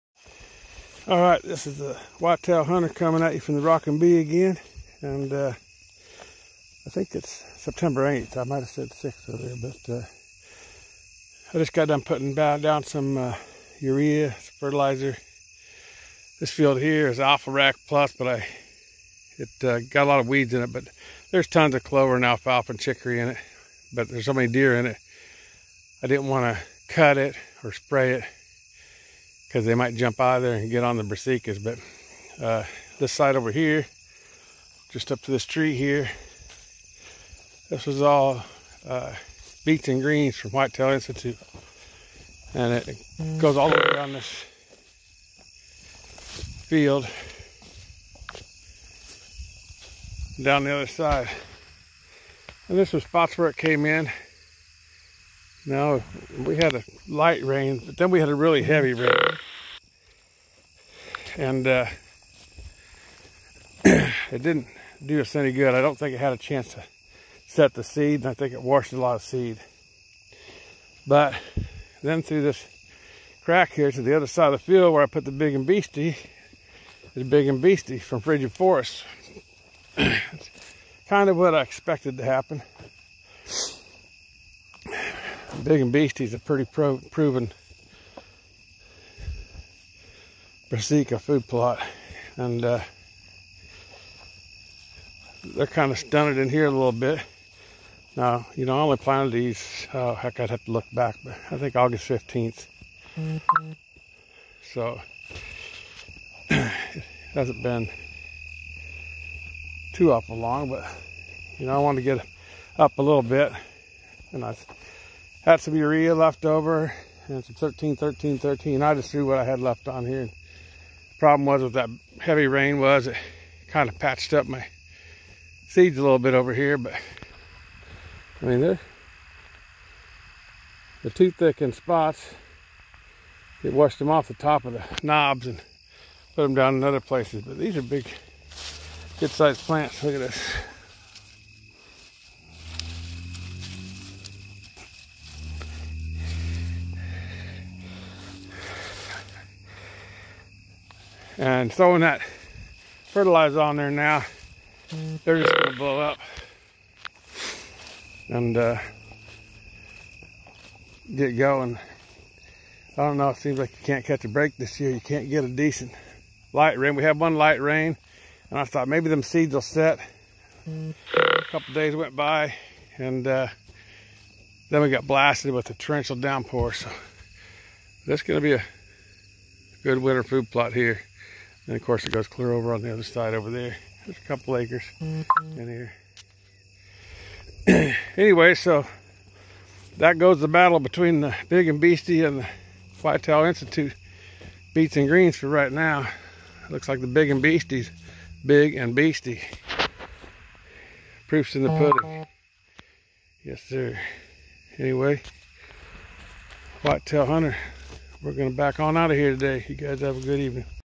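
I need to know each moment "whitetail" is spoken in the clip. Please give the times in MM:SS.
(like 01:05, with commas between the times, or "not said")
00:02, 00:40, 03:13, 03:26.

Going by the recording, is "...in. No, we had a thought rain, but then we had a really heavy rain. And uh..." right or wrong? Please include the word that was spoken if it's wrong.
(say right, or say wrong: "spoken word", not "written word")
wrong: "light", not "thought".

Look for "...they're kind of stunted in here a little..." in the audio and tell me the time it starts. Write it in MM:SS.
01:35.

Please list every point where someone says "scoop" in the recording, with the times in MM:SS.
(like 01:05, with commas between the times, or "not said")
not said.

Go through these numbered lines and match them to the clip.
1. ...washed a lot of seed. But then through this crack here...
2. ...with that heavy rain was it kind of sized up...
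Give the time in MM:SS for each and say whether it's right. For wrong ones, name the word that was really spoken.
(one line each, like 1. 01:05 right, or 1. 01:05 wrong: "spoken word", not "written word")
1. 01:08 right
2. 02:01 wrong: "patched", not "sized".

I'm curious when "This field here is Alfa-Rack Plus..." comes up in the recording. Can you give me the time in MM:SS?
00:16.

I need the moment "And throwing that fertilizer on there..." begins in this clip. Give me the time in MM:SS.
02:31.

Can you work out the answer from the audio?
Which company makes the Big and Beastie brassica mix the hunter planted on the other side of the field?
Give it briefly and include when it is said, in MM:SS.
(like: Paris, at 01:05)
Frigid Forest, at 01:18.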